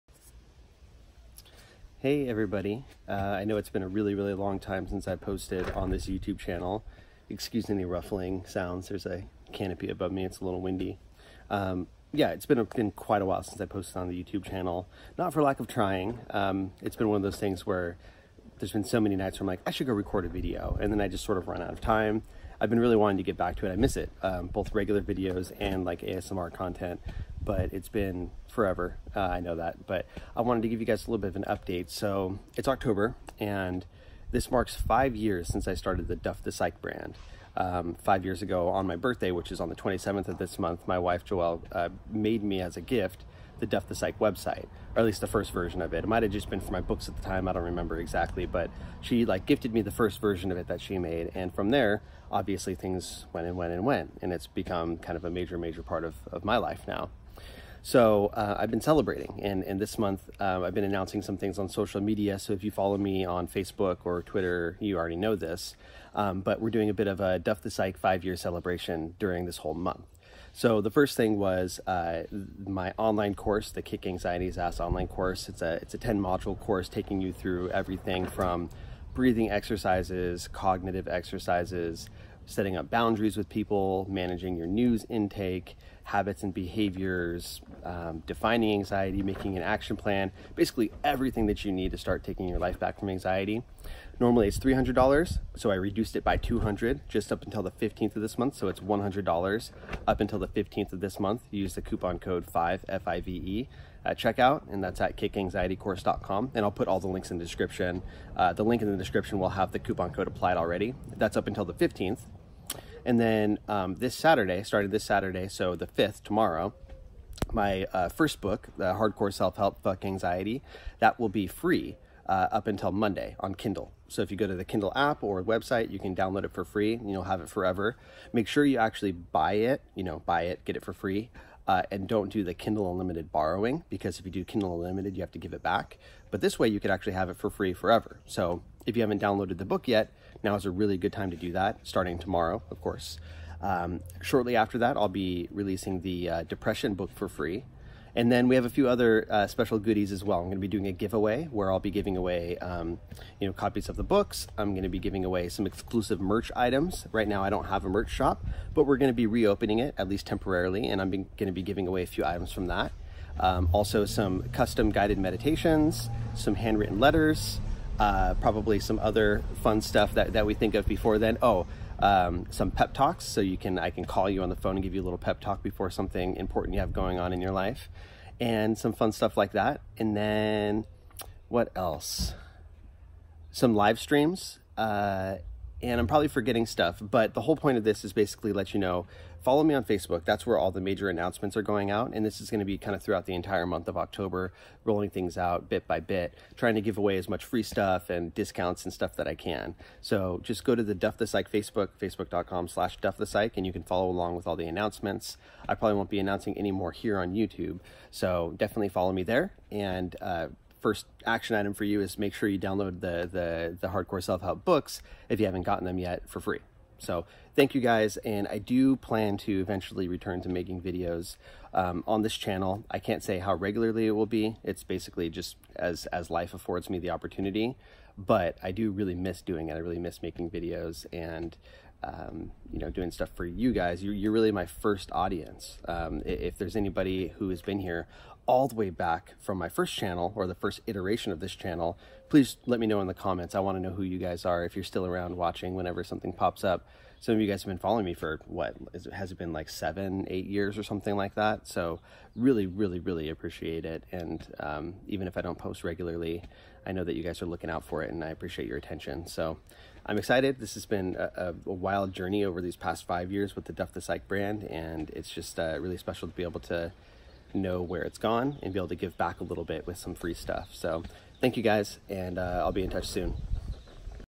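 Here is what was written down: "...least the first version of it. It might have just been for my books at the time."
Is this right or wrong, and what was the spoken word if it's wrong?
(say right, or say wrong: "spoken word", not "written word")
right.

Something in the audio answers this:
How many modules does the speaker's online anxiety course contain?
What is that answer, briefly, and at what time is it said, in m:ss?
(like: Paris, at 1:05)
10, at 1:15.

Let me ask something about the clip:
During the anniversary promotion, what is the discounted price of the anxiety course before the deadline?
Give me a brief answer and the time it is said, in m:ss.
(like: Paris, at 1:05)
$100, at 1:38.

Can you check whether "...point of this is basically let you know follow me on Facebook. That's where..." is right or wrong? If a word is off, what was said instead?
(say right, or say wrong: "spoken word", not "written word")
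right.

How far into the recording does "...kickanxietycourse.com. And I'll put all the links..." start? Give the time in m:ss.
1:45.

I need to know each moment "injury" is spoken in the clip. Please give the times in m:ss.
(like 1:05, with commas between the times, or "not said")
not said.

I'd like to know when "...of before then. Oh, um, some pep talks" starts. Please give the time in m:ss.
2:50.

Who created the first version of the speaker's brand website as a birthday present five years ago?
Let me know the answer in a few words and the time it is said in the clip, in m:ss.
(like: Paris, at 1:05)
Joelle, at 0:41.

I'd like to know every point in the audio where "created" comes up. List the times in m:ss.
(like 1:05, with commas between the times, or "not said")
not said.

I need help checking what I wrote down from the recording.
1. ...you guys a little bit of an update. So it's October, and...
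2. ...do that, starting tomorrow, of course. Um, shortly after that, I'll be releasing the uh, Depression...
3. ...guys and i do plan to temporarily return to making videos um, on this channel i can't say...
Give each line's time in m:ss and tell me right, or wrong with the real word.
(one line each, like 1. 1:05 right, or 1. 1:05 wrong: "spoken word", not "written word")
1. 0:30 right
2. 2:21 right
3. 3:37 wrong: "eventually", not "temporarily".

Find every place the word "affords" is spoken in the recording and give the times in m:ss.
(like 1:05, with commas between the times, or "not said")
3:46.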